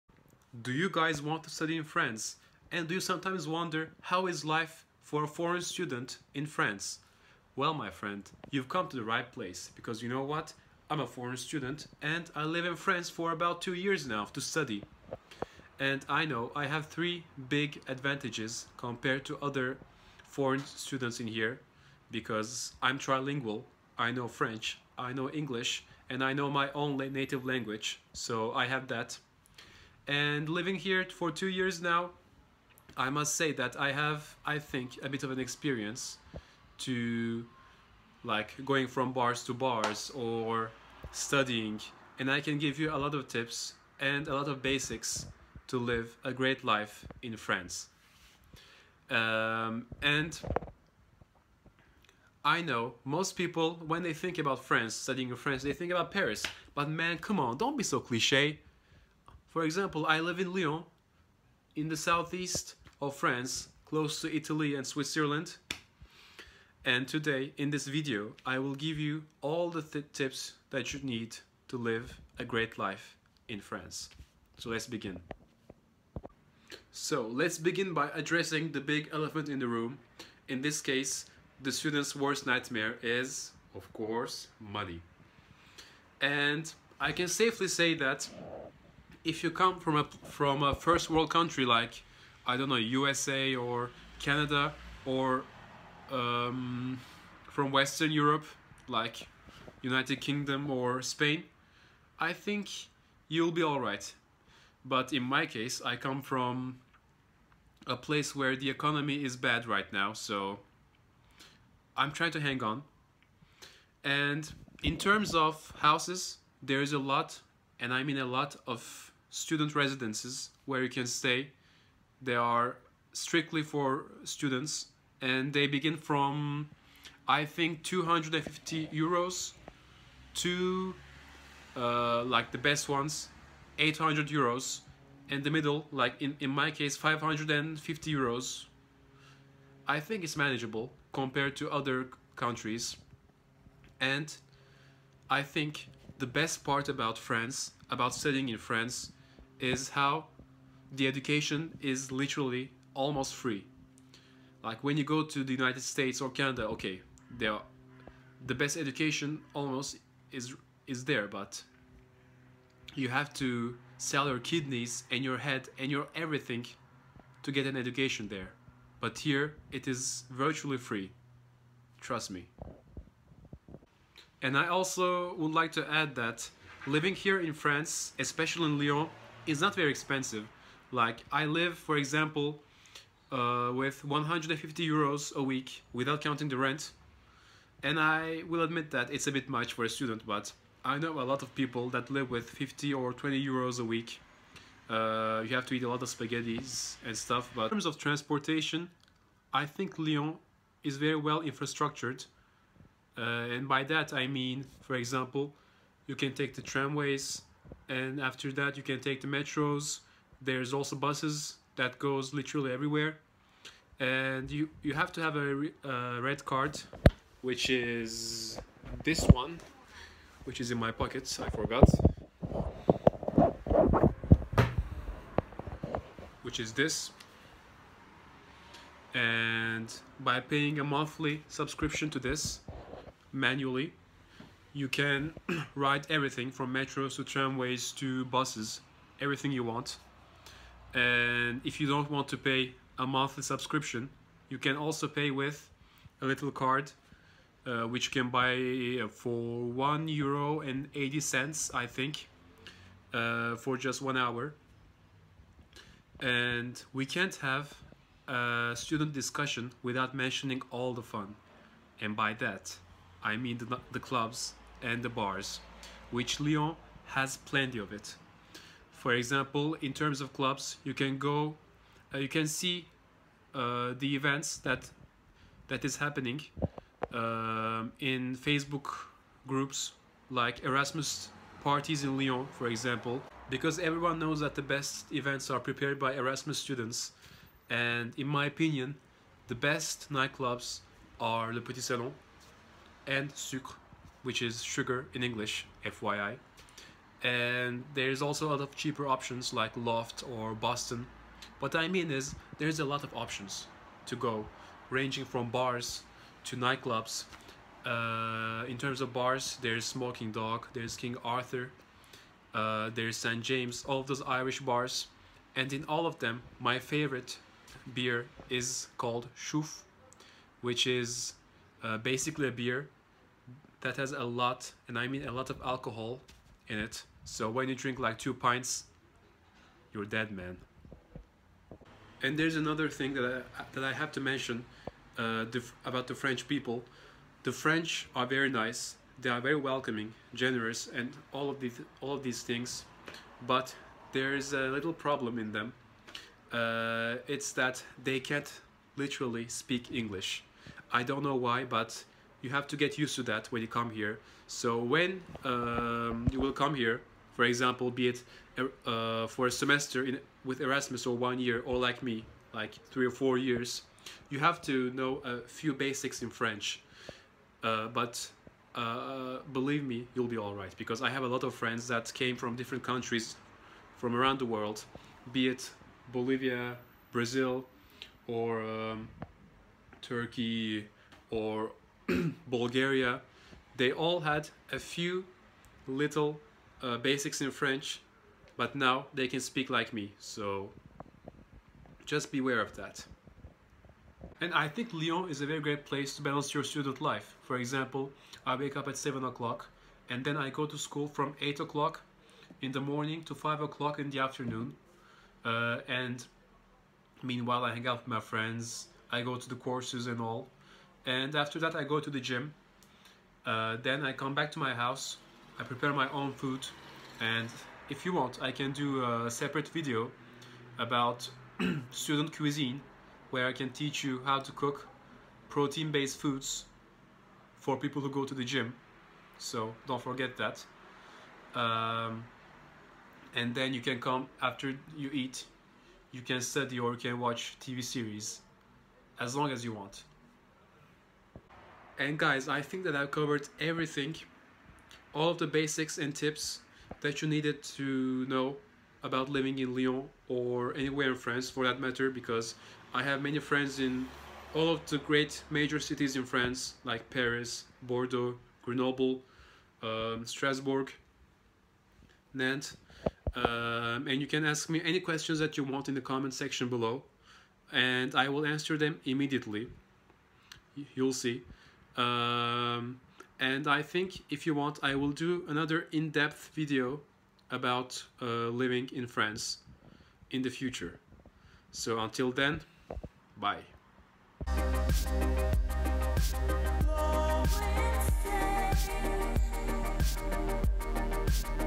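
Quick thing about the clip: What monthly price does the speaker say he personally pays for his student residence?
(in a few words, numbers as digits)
550 euros.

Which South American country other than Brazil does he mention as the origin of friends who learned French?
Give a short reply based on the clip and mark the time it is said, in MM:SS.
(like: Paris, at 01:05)
Bolivia, at 06:16.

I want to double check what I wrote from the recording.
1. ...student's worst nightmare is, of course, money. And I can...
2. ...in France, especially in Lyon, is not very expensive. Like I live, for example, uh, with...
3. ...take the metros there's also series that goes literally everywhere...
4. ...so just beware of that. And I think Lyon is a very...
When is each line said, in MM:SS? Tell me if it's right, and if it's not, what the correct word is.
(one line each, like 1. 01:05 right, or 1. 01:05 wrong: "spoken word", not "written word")
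1. 01:21 right
2. 02:57 right
3. 03:28 wrong: "buses", not "series"
4. 06:30 right.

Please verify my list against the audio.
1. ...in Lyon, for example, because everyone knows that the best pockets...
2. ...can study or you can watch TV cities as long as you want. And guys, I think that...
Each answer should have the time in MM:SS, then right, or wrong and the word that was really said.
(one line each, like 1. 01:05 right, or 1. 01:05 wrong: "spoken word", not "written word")
1. 04:42 wrong: "events", not "pockets"
2. 07:16 wrong: "series", not "cities".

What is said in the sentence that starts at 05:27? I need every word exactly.
So when you drink like two pints, you're dead, man.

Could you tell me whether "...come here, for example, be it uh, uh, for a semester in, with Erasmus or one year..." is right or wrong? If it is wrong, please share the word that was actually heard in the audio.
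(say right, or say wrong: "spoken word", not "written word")
right.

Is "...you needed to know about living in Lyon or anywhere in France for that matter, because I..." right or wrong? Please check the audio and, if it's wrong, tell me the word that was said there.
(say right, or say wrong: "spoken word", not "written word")
right.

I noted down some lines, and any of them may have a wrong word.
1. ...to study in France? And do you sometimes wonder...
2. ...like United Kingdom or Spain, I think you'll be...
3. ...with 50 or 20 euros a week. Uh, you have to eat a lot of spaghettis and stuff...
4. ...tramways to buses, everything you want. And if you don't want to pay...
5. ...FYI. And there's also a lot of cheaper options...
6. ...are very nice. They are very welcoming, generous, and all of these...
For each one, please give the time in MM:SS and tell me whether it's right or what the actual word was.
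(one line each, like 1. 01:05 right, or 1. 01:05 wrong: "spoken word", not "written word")
1. 00:01 right
2. 01:38 right
3. 03:12 right
4. 03:57 right
5. 04:55 right
6. 05:38 right.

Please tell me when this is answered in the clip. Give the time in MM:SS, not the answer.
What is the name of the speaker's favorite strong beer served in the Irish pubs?
05:19.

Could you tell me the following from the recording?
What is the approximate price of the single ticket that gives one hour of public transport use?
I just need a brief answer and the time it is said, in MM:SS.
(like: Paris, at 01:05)
1.80 euros, at 04:09.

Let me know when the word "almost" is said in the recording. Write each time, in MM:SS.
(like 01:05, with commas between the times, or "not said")
02:32, 02:39.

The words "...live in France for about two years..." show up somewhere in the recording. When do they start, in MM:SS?
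00:12.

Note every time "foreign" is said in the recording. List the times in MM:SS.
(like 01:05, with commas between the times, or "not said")
00:05, 00:11, 00:20.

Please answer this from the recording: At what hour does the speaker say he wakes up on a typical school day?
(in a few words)
7 o'clock.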